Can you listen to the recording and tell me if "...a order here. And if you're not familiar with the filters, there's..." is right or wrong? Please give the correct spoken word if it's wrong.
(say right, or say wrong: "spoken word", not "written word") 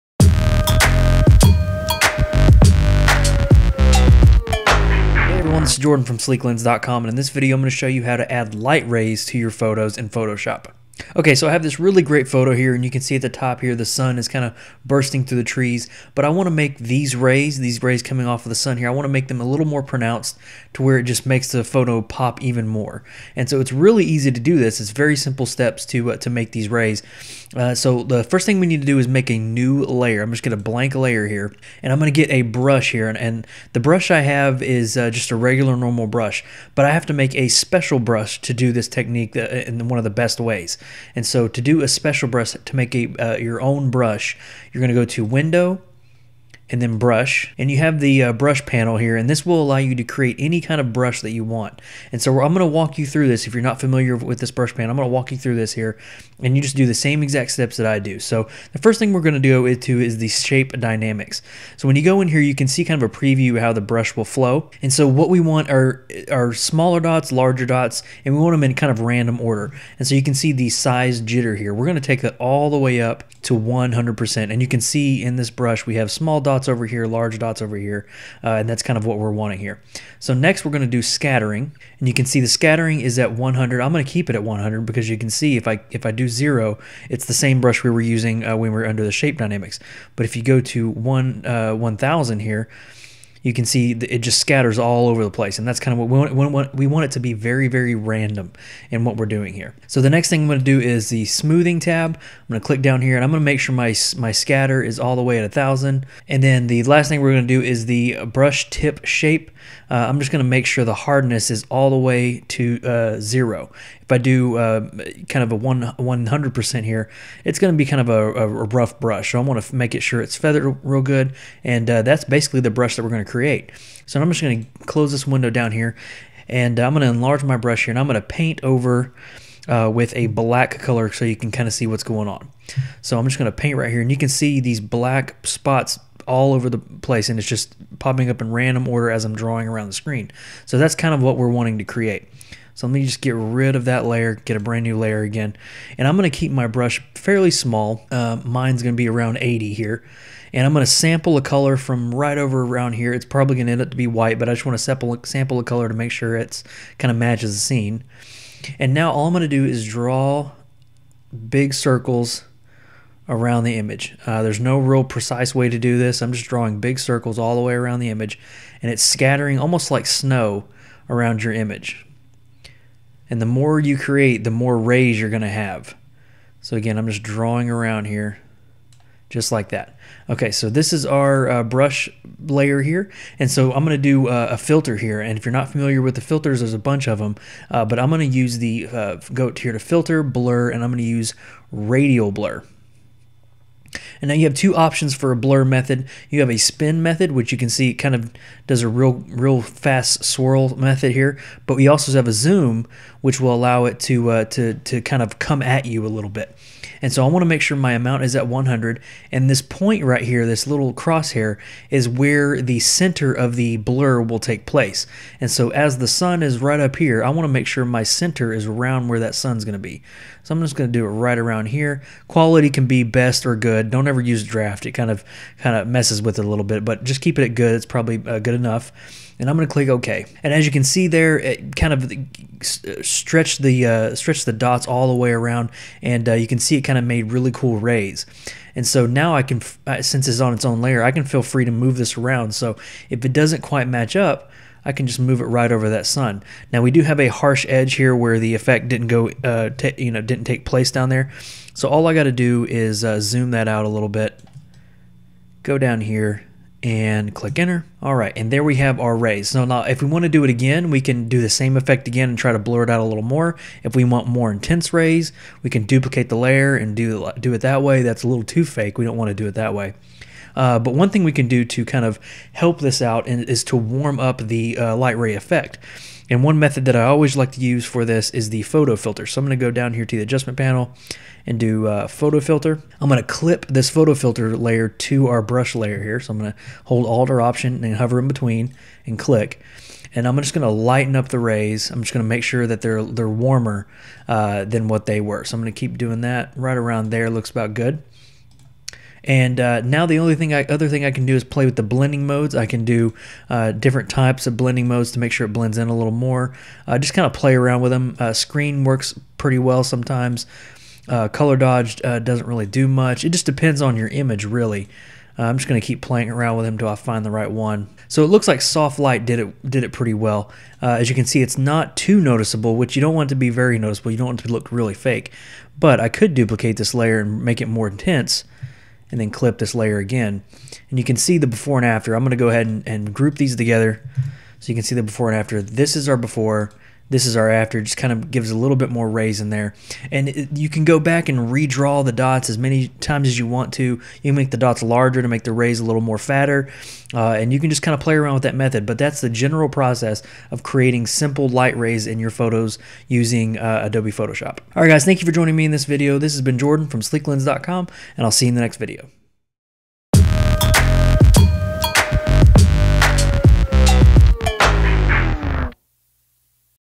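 wrong: "filter", not "order".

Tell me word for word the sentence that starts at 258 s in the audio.
All right, and there we have our rays.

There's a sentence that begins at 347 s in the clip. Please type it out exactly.
Uh, and you can just kind of play around with that method.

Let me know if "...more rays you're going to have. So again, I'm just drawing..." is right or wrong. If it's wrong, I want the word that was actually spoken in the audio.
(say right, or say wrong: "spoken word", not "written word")
right.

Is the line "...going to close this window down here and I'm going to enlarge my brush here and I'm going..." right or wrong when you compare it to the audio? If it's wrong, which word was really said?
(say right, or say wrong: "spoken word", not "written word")
right.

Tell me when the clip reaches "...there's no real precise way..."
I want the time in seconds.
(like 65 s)
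164 s.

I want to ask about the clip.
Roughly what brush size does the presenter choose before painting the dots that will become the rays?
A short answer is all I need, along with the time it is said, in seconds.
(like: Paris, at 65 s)
80, at 149 s.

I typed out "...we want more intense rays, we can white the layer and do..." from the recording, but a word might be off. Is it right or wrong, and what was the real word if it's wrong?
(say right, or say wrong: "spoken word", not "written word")
wrong: "duplicate", not "white".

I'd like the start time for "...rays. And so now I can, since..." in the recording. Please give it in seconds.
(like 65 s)
237 s.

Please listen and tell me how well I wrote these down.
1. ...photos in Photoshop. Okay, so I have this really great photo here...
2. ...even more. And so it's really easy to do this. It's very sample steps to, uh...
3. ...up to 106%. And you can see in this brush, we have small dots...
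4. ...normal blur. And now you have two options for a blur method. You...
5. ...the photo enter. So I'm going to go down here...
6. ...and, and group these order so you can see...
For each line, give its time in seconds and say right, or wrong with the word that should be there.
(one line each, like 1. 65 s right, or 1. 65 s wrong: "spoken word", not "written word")
1. 9 s right
2. 22 s wrong: "simple", not "sample"
3. 73 s wrong: "100", not "106"
4. 191 s wrong: "radial", not "normal"
5. 278 s wrong: "filter", not "enter"
6. 332 s wrong: "together", not "order".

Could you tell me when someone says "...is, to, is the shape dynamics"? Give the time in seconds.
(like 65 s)
59 s.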